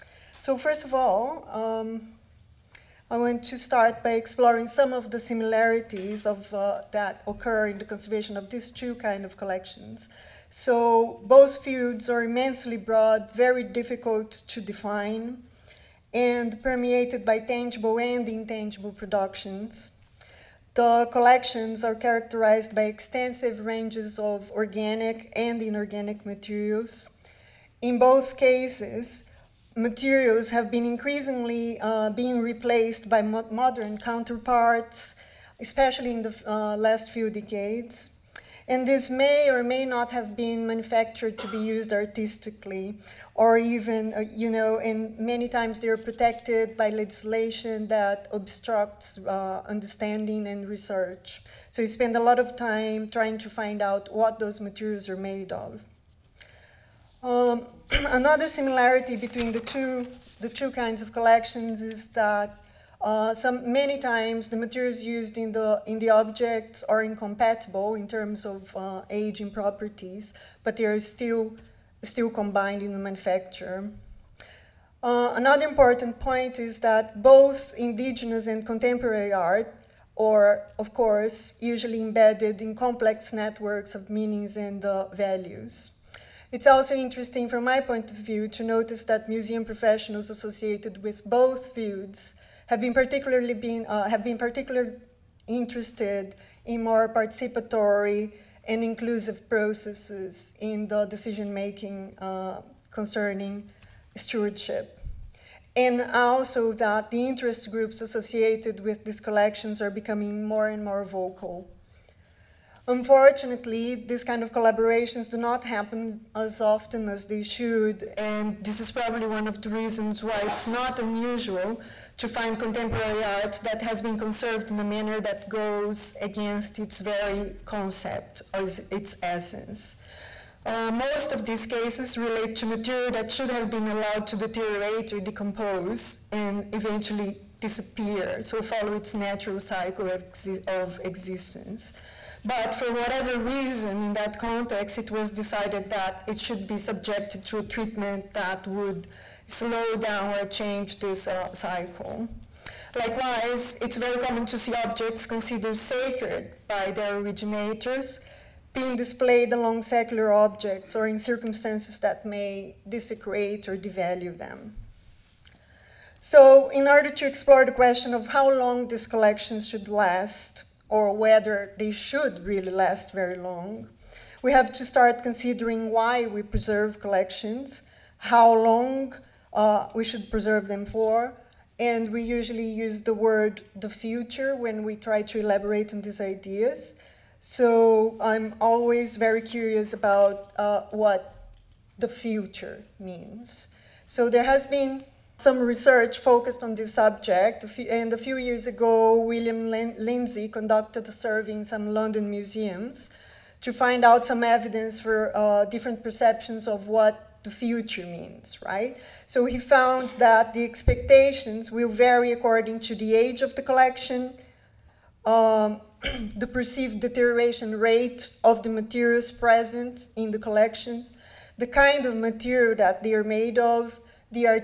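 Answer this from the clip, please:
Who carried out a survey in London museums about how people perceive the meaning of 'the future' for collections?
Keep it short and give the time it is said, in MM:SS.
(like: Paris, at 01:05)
William Lindsay, at 03:19.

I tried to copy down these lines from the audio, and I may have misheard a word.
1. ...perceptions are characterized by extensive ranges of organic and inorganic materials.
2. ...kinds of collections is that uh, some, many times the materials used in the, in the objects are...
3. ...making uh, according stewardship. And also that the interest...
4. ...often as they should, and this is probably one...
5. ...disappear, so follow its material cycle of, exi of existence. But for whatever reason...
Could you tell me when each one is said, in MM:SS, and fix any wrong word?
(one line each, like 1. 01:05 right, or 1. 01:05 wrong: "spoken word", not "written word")
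1. 00:21 wrong: "collections", not "perceptions"
2. 01:00 right
3. 01:41 wrong: "concerning", not "according"
4. 01:56 right
5. 02:17 wrong: "natural", not "material".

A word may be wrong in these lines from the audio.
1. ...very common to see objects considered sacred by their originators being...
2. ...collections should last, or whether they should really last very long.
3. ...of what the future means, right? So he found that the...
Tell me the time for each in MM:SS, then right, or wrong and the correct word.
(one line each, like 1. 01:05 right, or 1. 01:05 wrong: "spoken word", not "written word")
1. 02:33 right
2. 02:49 right
3. 03:26 right.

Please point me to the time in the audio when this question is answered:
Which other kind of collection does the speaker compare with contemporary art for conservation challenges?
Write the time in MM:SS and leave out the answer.
01:17.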